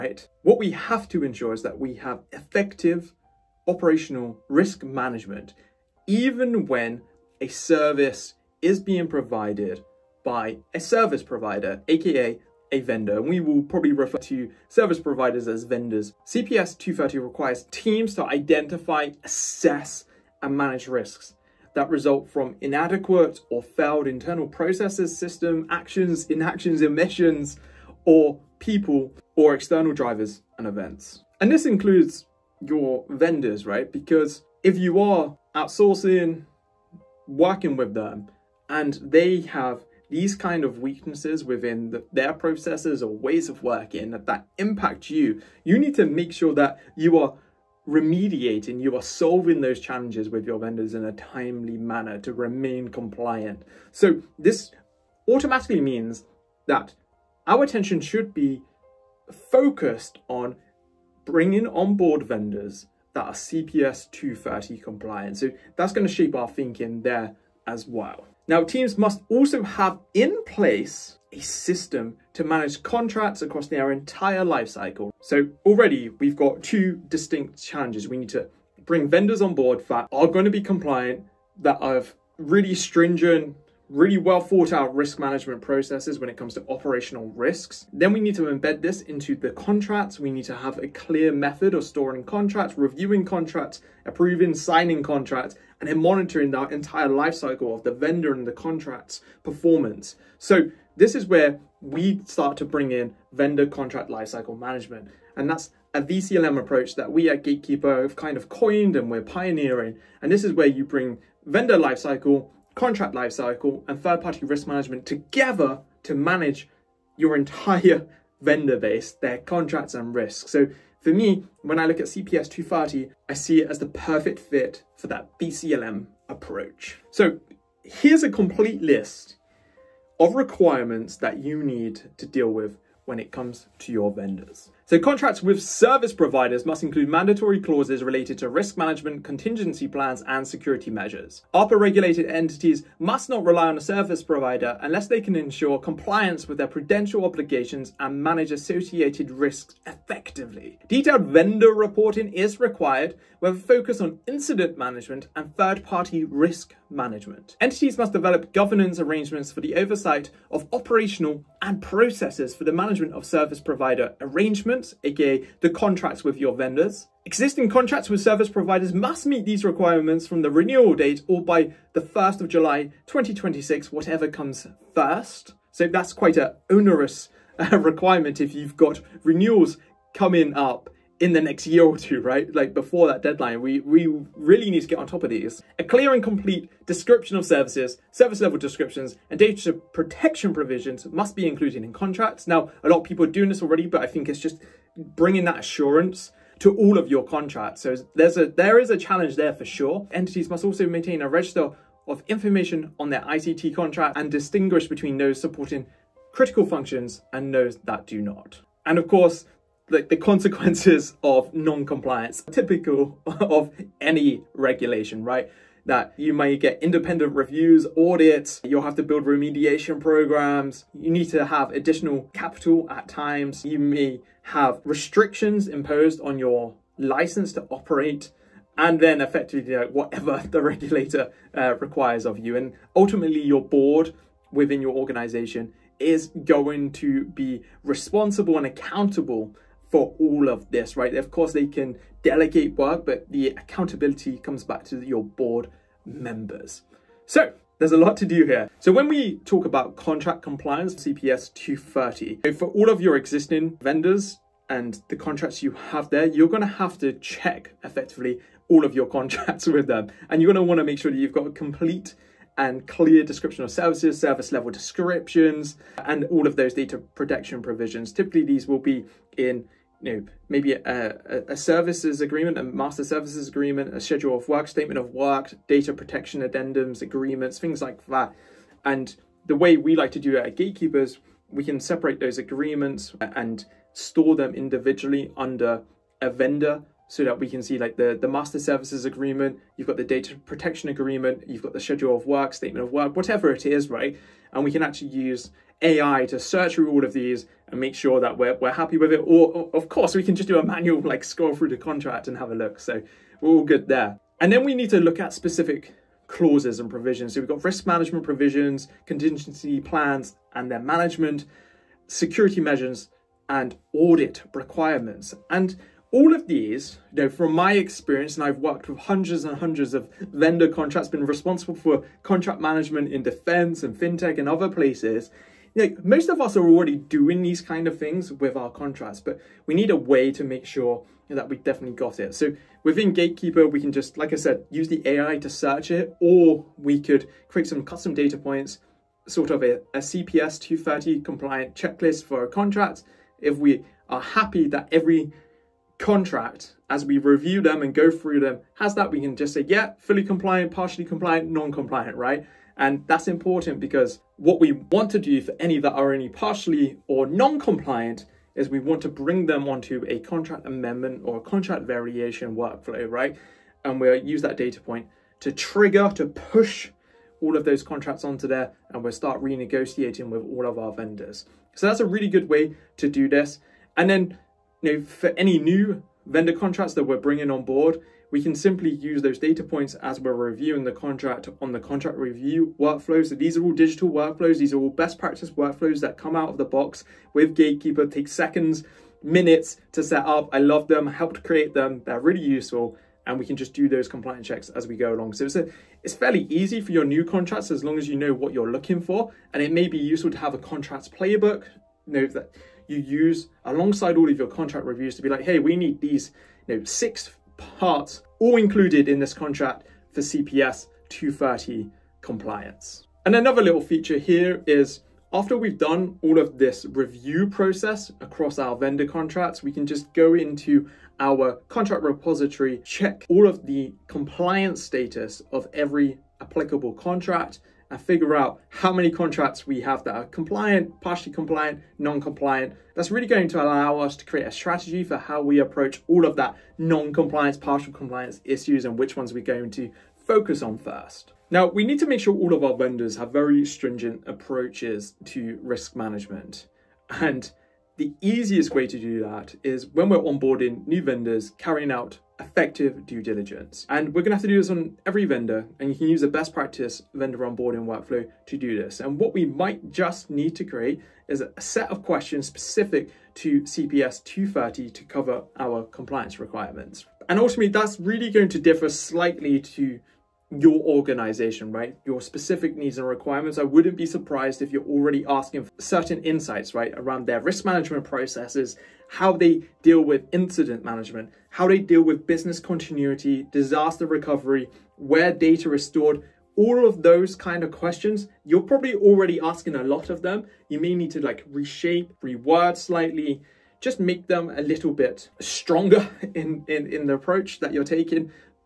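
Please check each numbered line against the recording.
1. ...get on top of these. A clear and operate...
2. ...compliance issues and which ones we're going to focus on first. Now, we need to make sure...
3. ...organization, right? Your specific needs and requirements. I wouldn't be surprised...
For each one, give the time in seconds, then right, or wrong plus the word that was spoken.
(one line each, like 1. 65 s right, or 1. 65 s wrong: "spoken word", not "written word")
1. 184 s wrong: "complete", not "operate"
2. 437 s right
3. 470 s right.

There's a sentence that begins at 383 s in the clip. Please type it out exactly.
So these are all digital workflows.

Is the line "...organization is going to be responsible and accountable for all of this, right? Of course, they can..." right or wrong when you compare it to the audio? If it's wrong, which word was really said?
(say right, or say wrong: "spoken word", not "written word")
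right.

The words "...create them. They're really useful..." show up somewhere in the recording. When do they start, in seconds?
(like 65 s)
391 s.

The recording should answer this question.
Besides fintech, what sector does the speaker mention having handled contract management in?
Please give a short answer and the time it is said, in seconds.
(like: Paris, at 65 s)
Defense, at 323 s.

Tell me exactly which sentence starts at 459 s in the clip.
And what we might just need to create is a set of questions specific to CPS 230 to cover our compliance requirements.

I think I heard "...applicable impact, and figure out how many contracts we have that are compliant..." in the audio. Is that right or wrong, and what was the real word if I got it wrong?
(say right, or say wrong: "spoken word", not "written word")
wrong: "contract", not "impact".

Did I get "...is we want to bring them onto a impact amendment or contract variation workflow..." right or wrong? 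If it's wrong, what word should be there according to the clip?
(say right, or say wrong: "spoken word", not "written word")
wrong: "contract", not "impact".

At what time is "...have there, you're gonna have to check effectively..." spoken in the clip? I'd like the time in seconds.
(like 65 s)
255 s.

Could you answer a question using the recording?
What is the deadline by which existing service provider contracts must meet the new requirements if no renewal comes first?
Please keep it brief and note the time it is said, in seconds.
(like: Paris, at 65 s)
1 July 2026, at 172 s.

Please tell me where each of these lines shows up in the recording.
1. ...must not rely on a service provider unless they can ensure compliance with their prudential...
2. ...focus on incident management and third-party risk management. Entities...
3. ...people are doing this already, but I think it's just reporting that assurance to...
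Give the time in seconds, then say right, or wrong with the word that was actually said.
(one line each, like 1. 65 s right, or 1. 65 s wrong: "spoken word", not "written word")
1. 142 s right
2. 153 s right
3. 193 s wrong: "bringing", not "reporting".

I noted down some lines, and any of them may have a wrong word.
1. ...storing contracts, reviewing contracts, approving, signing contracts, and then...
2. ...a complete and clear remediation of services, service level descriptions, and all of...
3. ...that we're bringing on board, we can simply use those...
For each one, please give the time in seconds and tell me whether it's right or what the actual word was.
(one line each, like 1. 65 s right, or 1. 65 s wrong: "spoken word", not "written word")
1. 91 s right
2. 261 s wrong: "description", not "remediation"
3. 376 s right.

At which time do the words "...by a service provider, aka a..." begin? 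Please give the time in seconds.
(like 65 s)
10 s.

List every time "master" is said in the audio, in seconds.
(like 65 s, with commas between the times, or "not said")
272 s, 288 s.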